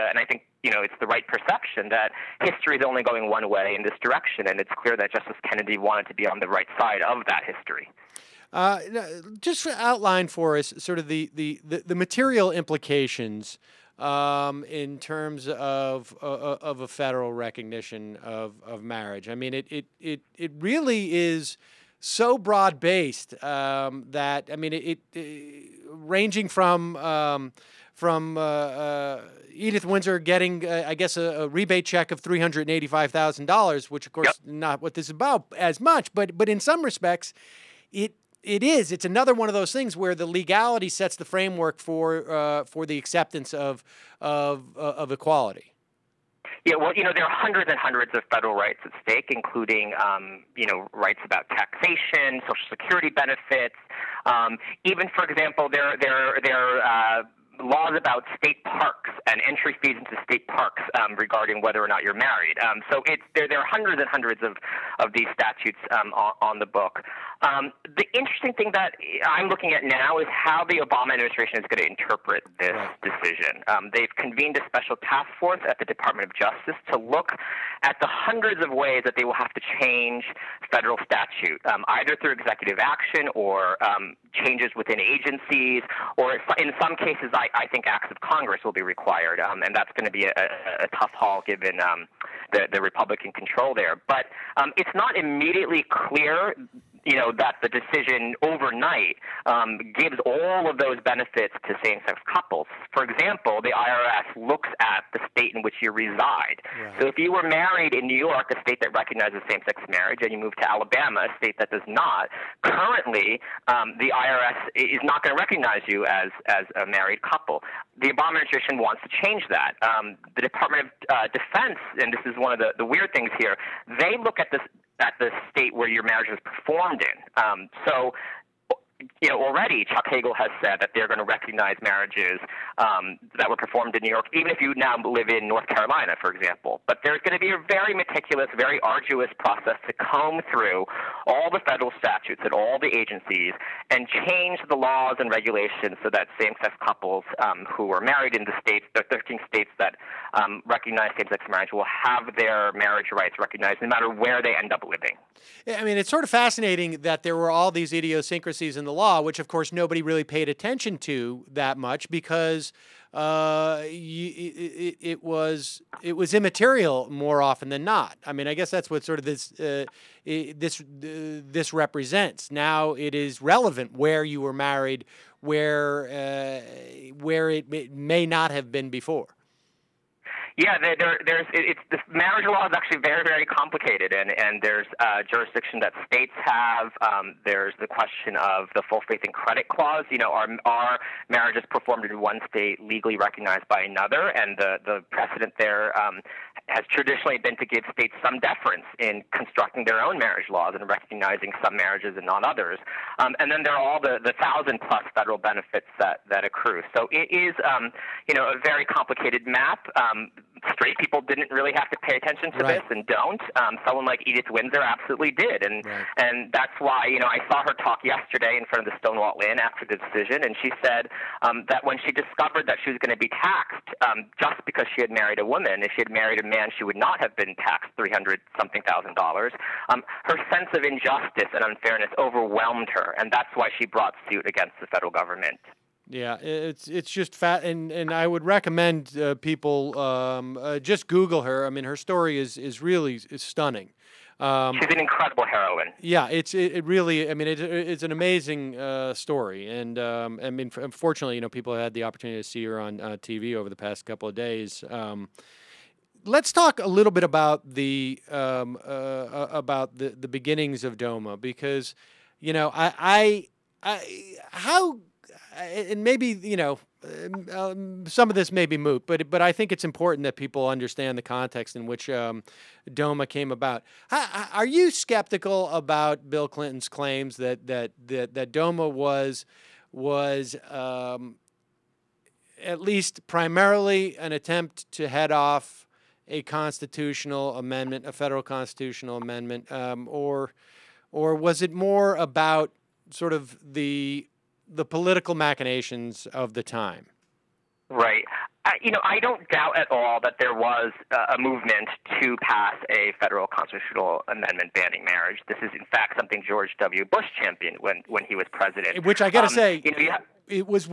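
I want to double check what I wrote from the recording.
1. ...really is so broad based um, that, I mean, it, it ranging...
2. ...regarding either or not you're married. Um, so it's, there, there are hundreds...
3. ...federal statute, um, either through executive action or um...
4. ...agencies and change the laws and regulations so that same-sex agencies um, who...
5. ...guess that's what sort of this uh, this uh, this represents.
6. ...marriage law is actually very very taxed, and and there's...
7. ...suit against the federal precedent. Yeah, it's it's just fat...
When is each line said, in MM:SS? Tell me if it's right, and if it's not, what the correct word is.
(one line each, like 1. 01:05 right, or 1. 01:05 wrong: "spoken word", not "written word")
1. 00:20 right
2. 01:01 wrong: "whether", not "either"
3. 01:20 right
4. 02:22 wrong: "couples", not "agencies"
5. 02:48 right
6. 03:02 wrong: "complicated", not "taxed"
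7. 03:54 wrong: "government", not "precedent".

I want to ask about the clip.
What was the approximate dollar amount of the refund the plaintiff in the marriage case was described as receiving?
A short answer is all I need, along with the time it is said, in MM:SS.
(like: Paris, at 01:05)
$385,000, at 00:32.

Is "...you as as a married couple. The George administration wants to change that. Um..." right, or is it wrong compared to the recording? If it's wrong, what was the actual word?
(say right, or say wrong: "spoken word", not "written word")
wrong: "Obama", not "George".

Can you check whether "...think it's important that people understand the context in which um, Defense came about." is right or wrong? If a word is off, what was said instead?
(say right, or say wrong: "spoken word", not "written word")
wrong: "DOMA", not "Defense".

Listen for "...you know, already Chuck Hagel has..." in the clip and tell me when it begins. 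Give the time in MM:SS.
02:09.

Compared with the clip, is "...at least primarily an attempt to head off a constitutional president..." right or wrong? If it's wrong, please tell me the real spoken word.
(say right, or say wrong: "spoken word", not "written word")
wrong: "amendment", not "president".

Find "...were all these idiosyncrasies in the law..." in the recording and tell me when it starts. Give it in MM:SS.
02:37.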